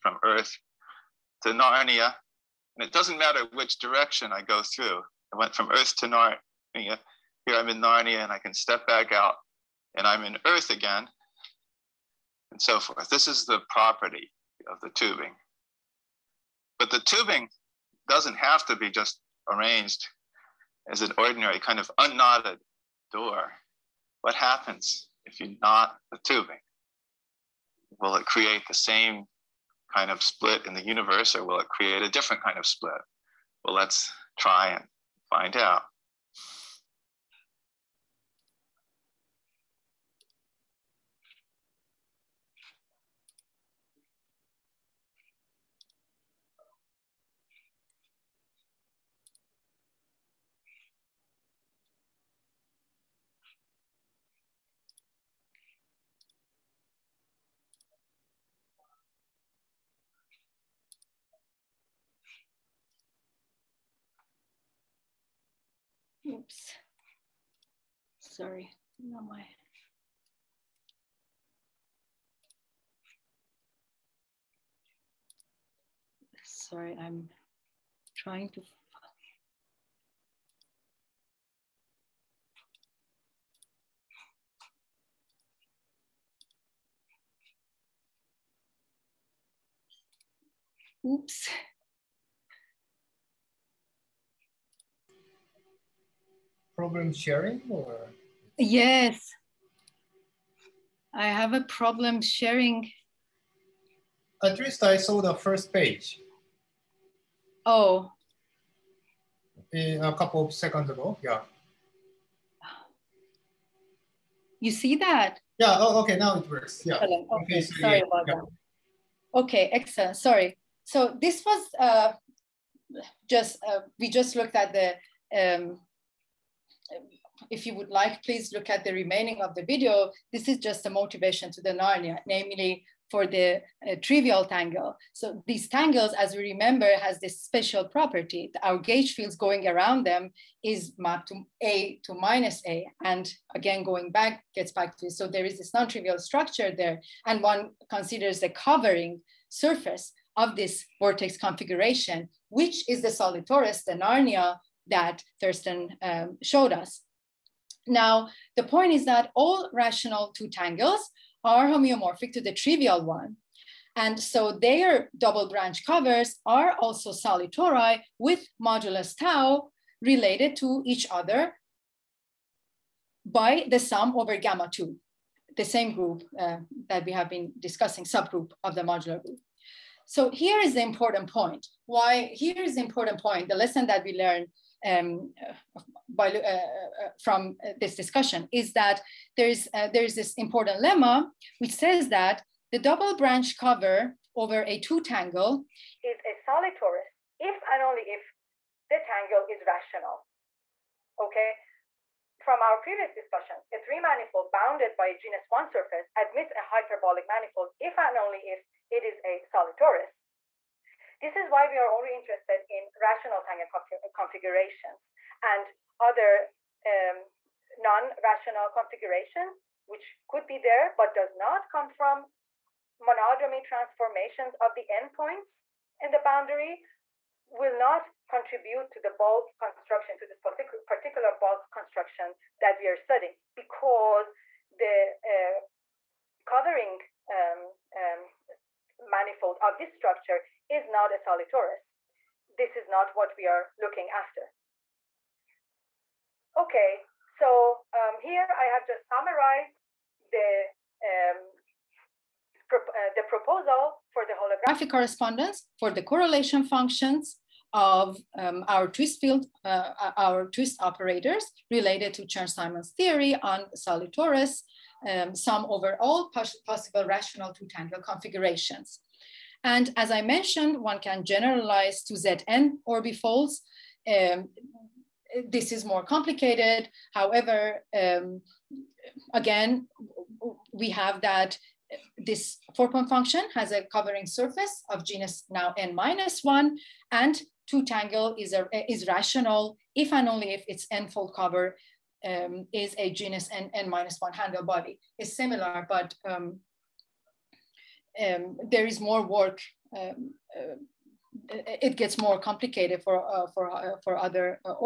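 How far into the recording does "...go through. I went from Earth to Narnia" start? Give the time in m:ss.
0:04.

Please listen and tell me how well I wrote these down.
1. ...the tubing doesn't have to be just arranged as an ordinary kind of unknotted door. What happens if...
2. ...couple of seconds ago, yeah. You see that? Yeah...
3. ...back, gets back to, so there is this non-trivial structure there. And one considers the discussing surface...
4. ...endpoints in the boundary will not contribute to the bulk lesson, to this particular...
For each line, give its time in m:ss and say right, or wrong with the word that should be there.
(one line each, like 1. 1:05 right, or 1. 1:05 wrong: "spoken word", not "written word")
1. 0:16 right
2. 1:50 right
3. 2:24 wrong: "covering", not "discussing"
4. 3:44 wrong: "construction", not "lesson".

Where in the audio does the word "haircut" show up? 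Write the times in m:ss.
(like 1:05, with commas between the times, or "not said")
not said.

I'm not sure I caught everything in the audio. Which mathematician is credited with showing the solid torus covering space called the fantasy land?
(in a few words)
Thurston.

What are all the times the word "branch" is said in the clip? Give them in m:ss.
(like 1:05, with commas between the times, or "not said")
2:45, 3:13.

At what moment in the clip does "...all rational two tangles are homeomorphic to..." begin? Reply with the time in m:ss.
2:39.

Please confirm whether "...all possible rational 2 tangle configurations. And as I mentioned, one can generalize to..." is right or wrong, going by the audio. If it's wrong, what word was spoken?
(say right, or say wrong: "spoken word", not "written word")
right.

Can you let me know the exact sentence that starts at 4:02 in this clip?
This is not what we are looking after.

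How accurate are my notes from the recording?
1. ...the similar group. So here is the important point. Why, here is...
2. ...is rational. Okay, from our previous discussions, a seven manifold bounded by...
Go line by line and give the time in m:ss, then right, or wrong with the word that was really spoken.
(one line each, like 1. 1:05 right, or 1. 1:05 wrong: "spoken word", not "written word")
1. 2:58 wrong: "modular", not "similar"
2. 3:19 wrong: "three", not "seven".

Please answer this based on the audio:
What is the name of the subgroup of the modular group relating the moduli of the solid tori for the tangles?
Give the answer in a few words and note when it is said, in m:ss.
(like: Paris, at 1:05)
gamma 2, at 2:54.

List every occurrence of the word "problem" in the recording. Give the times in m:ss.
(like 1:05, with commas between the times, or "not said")
1:36, 1:41.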